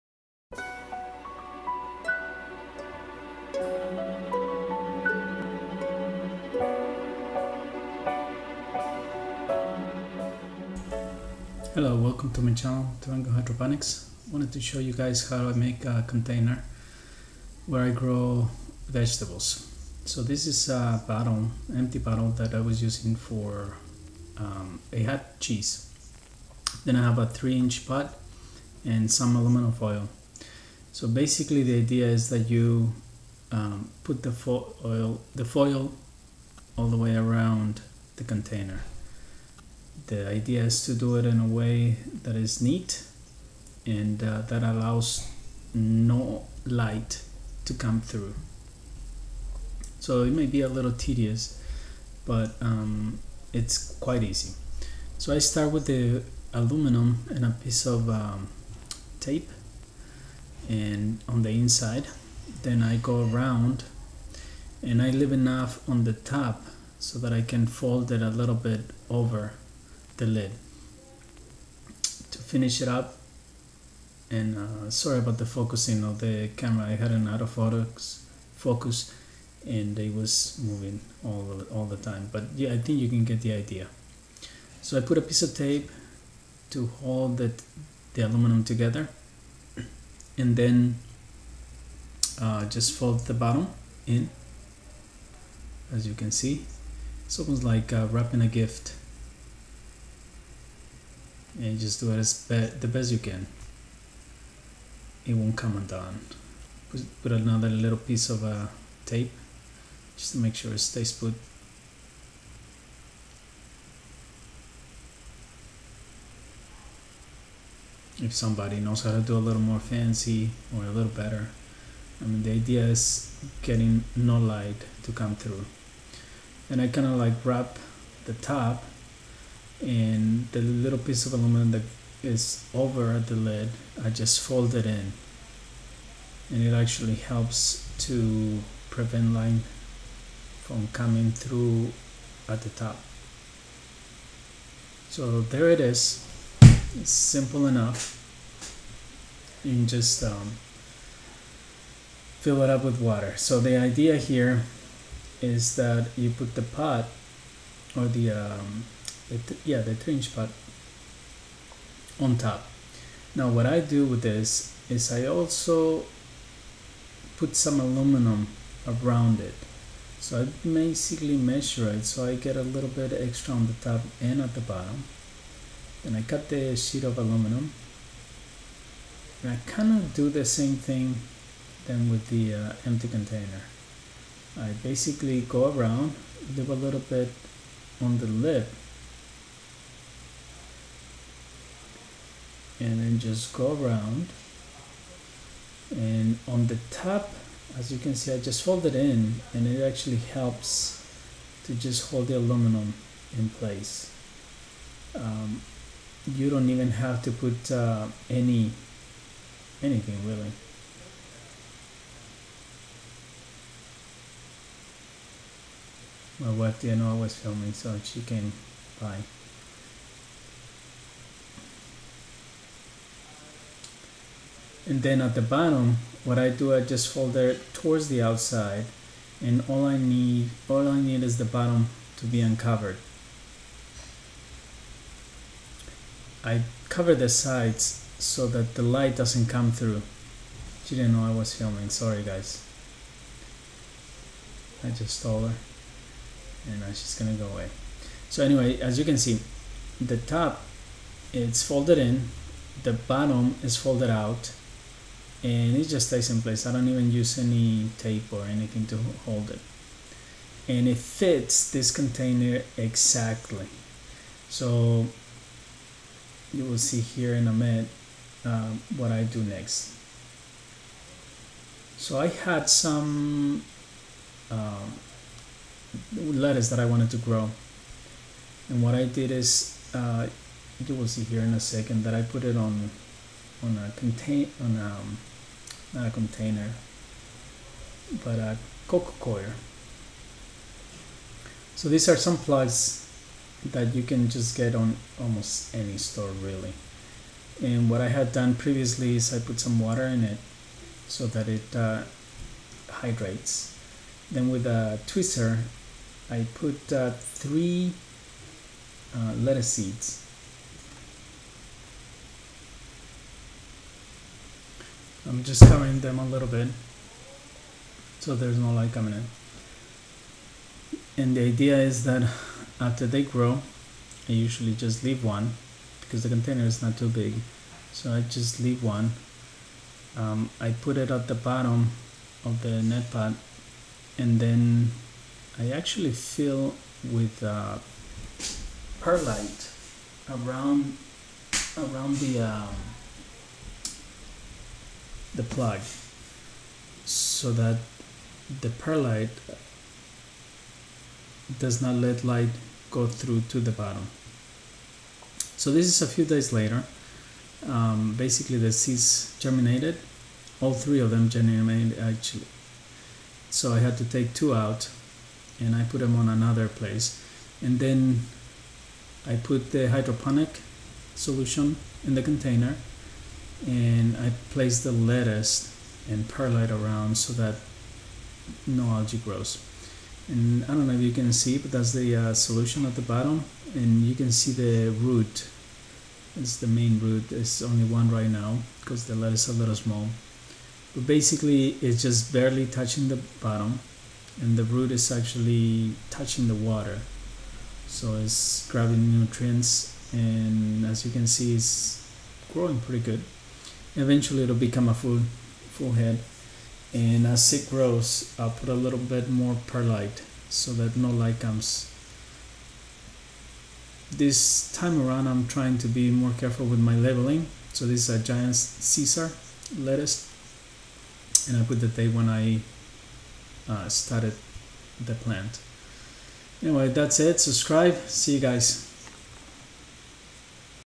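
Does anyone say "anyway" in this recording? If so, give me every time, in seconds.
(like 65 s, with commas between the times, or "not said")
248 s, 426 s.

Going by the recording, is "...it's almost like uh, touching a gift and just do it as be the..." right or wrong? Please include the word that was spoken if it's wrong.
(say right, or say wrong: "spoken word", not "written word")
wrong: "wrapping", not "touching".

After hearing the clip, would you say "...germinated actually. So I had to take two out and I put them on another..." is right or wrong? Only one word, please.
right.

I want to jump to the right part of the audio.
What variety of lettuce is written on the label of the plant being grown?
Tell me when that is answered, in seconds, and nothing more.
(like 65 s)
418 s.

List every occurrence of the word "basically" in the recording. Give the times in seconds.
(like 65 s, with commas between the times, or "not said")
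31 s, 170 s, 184 s, 358 s, 391 s.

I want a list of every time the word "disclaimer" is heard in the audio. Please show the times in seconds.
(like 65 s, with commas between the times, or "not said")
not said.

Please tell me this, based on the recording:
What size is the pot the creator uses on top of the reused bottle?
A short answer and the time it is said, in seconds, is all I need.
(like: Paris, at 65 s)
3 inch, at 27 s.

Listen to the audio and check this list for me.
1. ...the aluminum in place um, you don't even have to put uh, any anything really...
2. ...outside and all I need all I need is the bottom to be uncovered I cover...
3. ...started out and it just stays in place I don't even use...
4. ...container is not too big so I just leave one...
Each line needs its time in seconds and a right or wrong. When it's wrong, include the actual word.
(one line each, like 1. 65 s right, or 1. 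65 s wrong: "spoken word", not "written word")
1. 202 s right
2. 228 s right
3. 253 s wrong: "folded", not "started"
4. 326 s right.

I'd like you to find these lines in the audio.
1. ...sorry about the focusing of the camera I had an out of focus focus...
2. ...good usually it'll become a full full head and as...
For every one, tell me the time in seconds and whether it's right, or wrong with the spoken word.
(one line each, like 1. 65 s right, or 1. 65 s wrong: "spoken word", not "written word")
1. 74 s right
2. 403 s wrong: "eventually", not "usually".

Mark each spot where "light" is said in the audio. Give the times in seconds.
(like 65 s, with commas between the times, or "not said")
46 s, 124 s, 238 s, 318 s, 352 s, 411 s.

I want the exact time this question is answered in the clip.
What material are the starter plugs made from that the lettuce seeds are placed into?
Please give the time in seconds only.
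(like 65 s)
288 s.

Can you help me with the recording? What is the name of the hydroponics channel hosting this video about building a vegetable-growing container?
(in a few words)
Durango Hydroponics.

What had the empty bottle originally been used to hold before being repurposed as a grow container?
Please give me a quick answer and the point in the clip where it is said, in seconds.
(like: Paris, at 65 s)
cheese, at 25 s.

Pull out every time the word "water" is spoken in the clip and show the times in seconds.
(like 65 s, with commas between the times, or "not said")
153 s, 299 s, 396 s.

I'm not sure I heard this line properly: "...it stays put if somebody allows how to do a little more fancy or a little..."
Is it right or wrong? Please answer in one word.
wrong.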